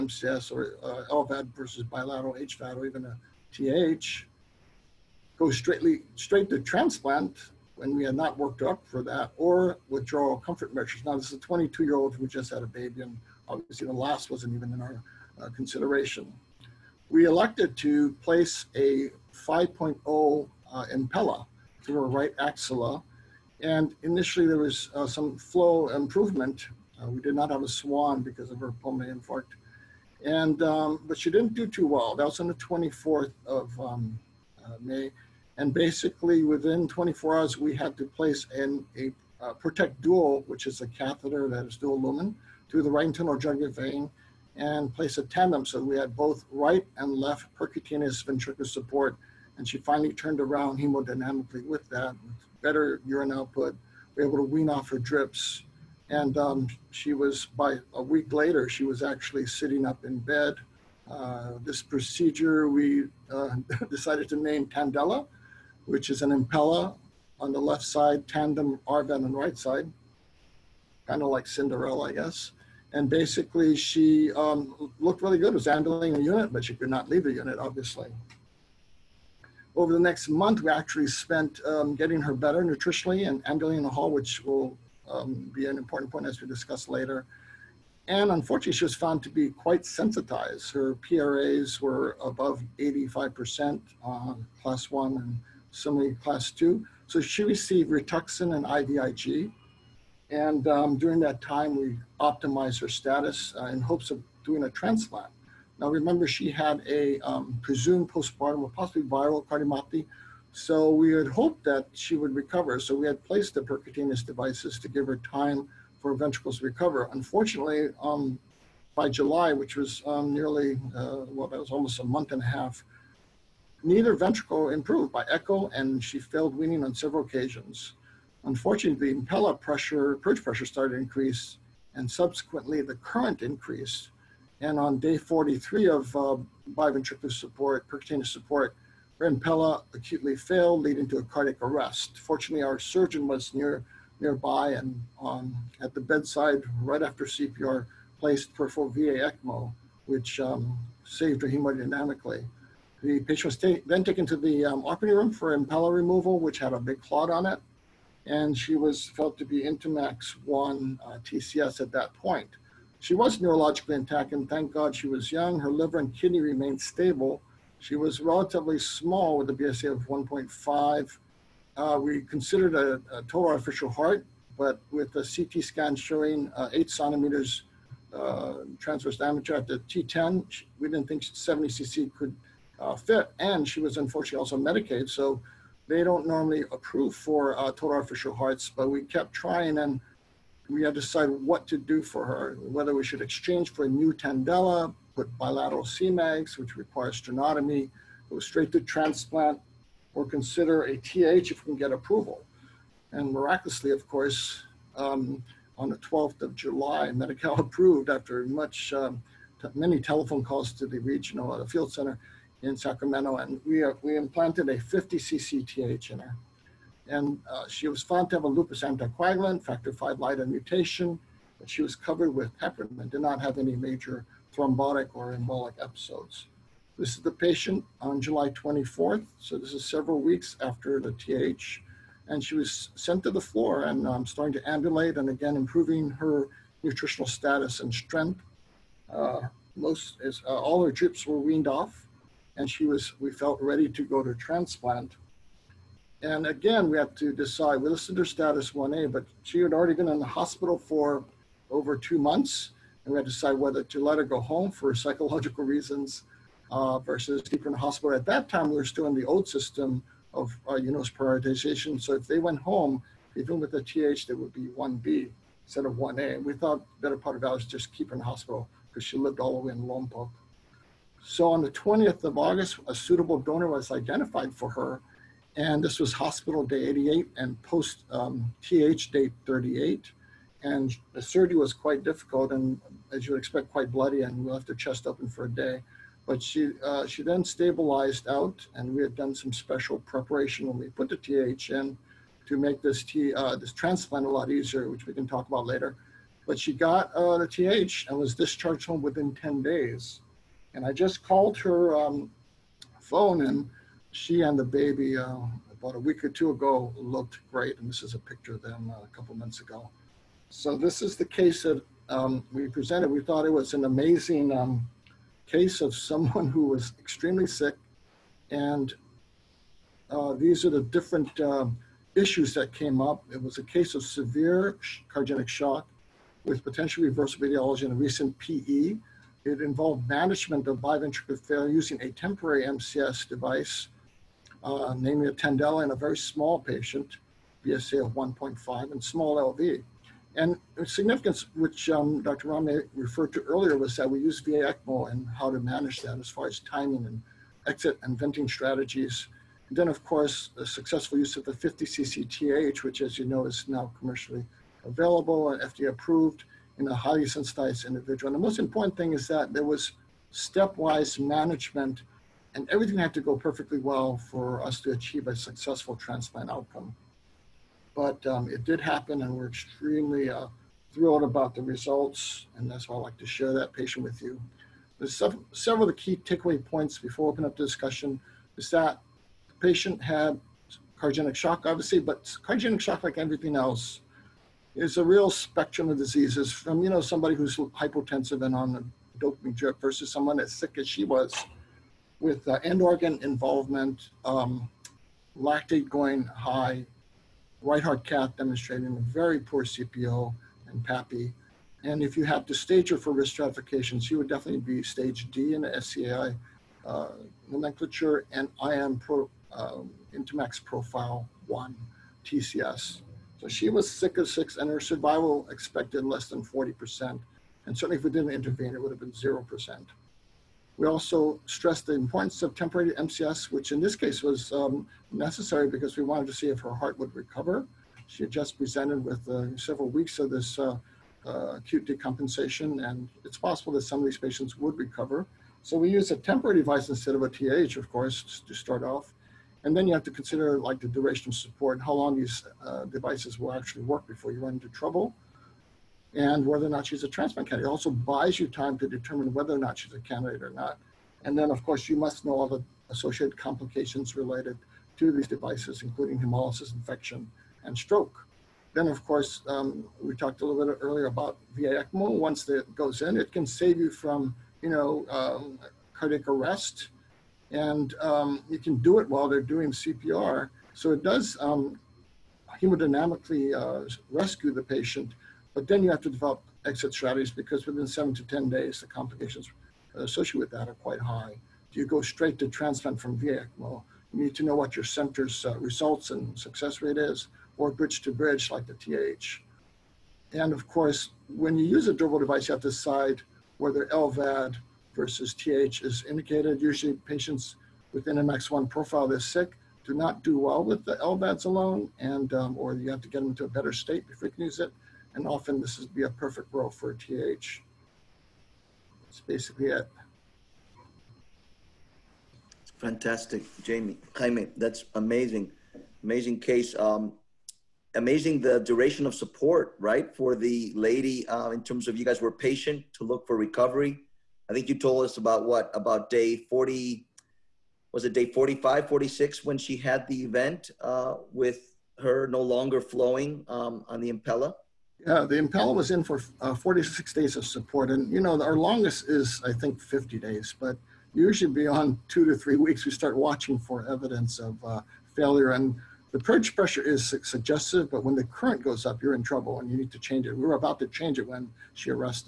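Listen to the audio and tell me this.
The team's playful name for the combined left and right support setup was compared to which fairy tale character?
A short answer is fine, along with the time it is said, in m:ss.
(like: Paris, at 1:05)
Cinderella, at 1:11.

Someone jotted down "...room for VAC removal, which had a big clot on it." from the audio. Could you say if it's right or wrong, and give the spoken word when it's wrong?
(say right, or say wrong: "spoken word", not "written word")
wrong: "Impella", not "VAC".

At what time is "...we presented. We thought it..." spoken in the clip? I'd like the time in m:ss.
5:12.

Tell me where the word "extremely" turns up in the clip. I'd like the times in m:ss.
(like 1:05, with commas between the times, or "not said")
5:16, 6:09.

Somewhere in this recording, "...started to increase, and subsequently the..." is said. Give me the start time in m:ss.
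2:10.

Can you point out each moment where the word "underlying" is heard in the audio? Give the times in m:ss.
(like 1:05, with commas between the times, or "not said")
not said.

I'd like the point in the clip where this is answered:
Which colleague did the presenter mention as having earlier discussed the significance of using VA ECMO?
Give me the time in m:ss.
5:42.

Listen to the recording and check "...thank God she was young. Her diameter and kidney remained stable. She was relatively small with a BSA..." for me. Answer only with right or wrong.
wrong.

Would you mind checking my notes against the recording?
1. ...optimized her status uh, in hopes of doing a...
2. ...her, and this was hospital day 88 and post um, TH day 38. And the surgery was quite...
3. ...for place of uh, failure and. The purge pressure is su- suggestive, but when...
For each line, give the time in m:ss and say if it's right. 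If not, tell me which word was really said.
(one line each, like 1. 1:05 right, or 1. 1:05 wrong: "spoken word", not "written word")
1. 1:42 right
2. 4:34 right
3. 9:03 wrong: "evidence", not "place".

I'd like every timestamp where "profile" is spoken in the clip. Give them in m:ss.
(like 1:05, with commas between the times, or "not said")
6:50, 8:18.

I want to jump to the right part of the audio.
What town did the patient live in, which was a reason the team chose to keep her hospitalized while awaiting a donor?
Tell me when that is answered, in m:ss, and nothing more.
4:29.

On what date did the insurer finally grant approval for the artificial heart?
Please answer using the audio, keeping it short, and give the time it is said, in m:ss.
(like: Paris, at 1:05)
July 12, at 3:25.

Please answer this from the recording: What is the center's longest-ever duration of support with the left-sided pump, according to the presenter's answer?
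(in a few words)
50 days.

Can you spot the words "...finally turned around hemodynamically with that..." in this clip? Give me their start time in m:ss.
0:49.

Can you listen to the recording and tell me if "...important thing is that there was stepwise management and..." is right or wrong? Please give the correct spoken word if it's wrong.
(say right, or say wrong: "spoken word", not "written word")
right.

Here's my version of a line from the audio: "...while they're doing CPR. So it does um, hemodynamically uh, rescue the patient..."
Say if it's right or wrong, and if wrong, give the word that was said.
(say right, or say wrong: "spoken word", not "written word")
right.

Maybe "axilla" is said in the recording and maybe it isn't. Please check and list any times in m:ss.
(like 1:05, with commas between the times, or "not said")
0:22.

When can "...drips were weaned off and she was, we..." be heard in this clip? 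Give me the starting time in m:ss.
4:00.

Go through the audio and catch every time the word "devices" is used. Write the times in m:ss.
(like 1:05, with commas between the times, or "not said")
1:54, 5:33, 7:16, 7:22, 7:35, 8:12.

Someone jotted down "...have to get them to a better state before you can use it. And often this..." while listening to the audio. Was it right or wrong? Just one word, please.
right.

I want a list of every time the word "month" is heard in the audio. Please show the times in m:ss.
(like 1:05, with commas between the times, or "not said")
1:20, 2:02, 4:12, 5:09.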